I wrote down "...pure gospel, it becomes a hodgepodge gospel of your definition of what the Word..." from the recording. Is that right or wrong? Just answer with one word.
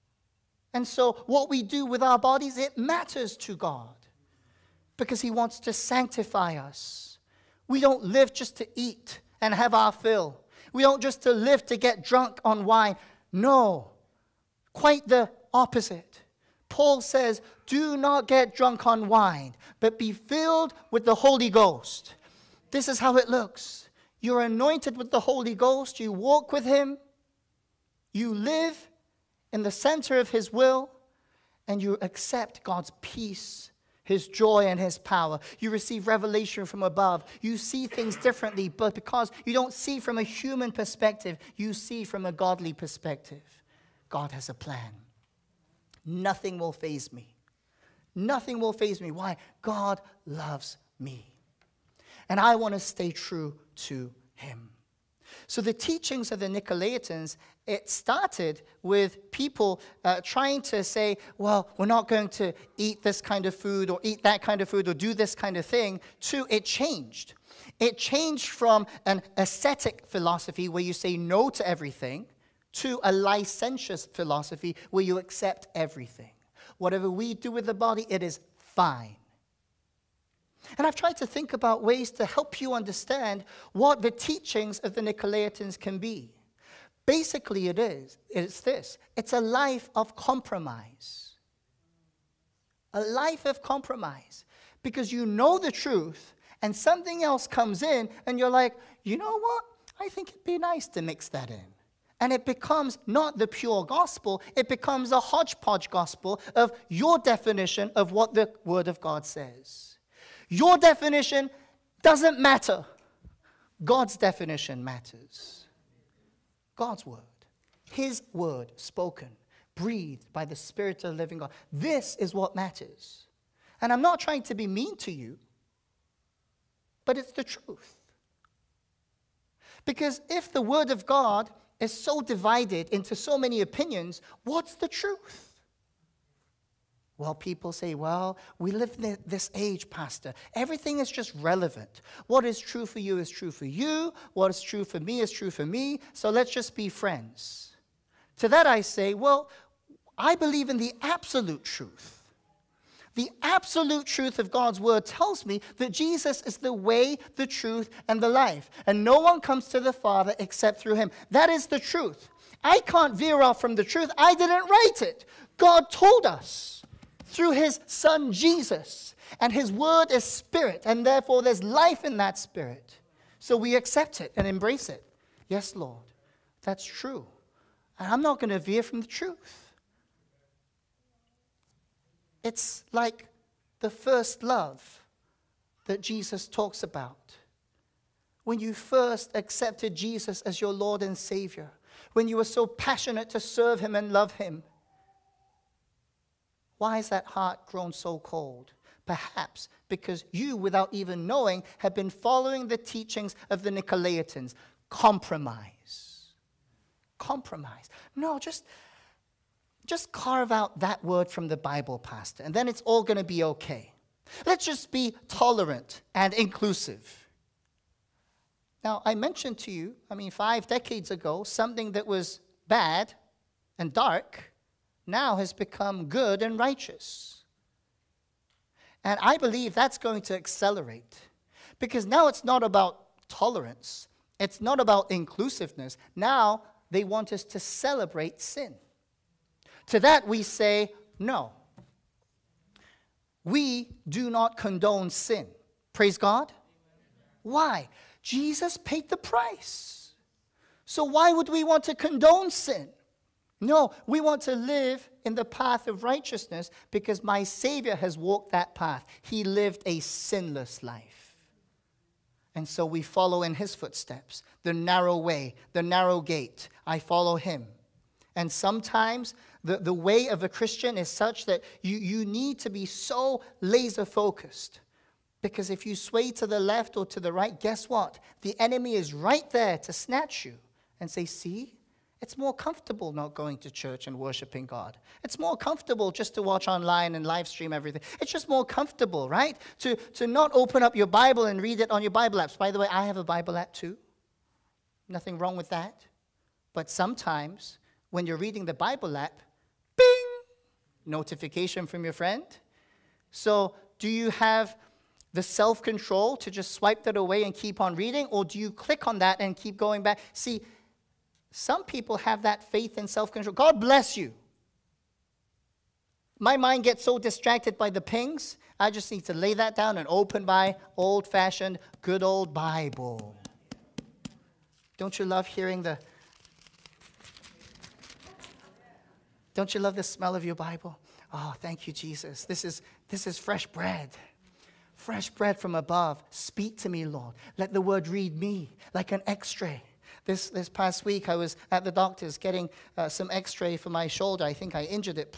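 right.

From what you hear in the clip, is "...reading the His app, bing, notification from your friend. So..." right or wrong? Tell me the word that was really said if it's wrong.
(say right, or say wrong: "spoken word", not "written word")
wrong: "Bible", not "His".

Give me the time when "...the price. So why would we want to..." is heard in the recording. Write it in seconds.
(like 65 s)
249 s.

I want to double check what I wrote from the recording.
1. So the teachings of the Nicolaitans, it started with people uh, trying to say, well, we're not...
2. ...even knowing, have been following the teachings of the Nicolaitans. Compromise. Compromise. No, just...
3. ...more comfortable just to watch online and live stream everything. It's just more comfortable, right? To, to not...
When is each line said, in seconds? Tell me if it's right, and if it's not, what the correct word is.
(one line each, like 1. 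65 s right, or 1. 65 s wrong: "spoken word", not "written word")
1. 55 s right
2. 200 s right
3. 285 s right.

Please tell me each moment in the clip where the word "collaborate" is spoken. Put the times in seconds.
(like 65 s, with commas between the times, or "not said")
not said.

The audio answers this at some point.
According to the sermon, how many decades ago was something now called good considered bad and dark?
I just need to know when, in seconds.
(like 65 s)
220 s.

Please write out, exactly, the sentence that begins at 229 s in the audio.
And I believe that's going to accelerate because now it's not about tolerance, it's not about inclusiveness.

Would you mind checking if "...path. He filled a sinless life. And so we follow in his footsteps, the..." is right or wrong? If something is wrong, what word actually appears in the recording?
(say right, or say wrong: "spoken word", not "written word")
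wrong: "lived", not "filled".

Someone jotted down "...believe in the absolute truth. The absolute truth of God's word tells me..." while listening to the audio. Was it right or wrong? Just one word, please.
right.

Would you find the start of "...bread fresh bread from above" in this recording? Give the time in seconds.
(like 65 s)
333 s.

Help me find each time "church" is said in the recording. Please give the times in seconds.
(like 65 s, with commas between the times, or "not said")
283 s.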